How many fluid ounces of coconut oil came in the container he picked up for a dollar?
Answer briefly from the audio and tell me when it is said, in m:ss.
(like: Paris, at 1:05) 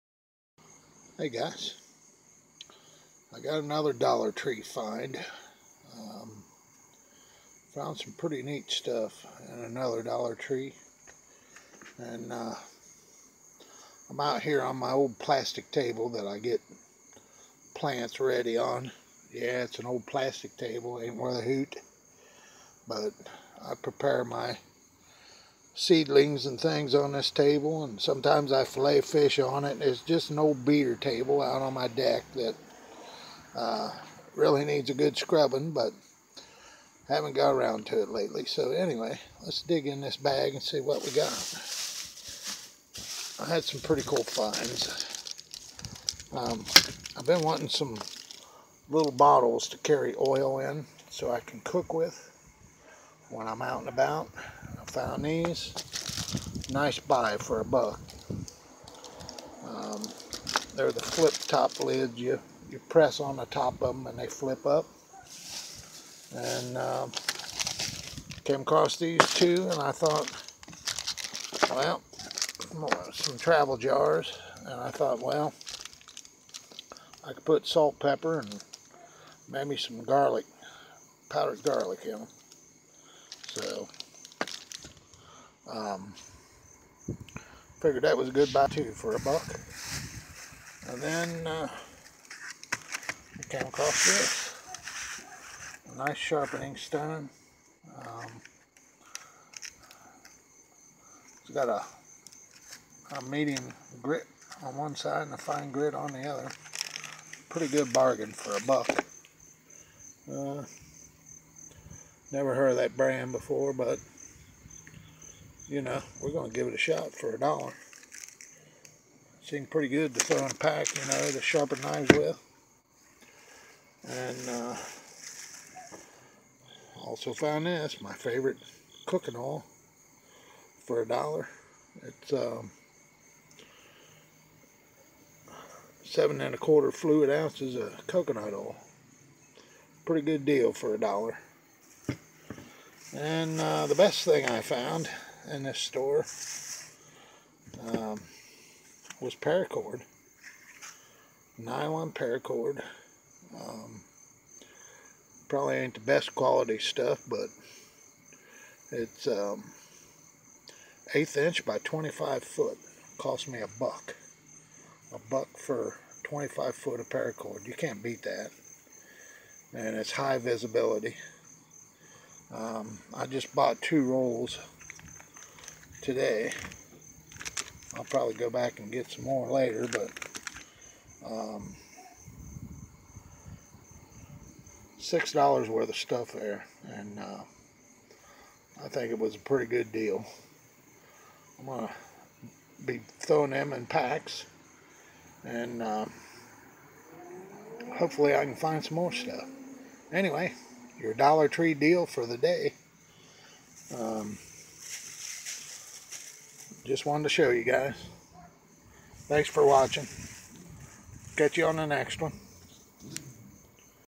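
7.25, at 2:16.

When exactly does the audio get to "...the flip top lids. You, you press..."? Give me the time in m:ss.
1:00.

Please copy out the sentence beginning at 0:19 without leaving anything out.
Yeah, it's an old plastic table, ain't worth a hoot.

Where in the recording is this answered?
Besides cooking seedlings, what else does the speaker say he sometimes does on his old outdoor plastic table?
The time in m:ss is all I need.
0:28.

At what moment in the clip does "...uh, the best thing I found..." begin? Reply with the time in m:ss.
2:23.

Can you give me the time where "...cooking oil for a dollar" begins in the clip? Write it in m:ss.
2:09.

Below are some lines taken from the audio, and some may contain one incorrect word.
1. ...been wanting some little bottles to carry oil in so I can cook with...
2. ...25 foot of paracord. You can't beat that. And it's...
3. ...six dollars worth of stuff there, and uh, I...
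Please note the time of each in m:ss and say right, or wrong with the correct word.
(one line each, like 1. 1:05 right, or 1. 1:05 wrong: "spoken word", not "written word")
1. 0:47 right
2. 2:46 right
3. 3:04 right.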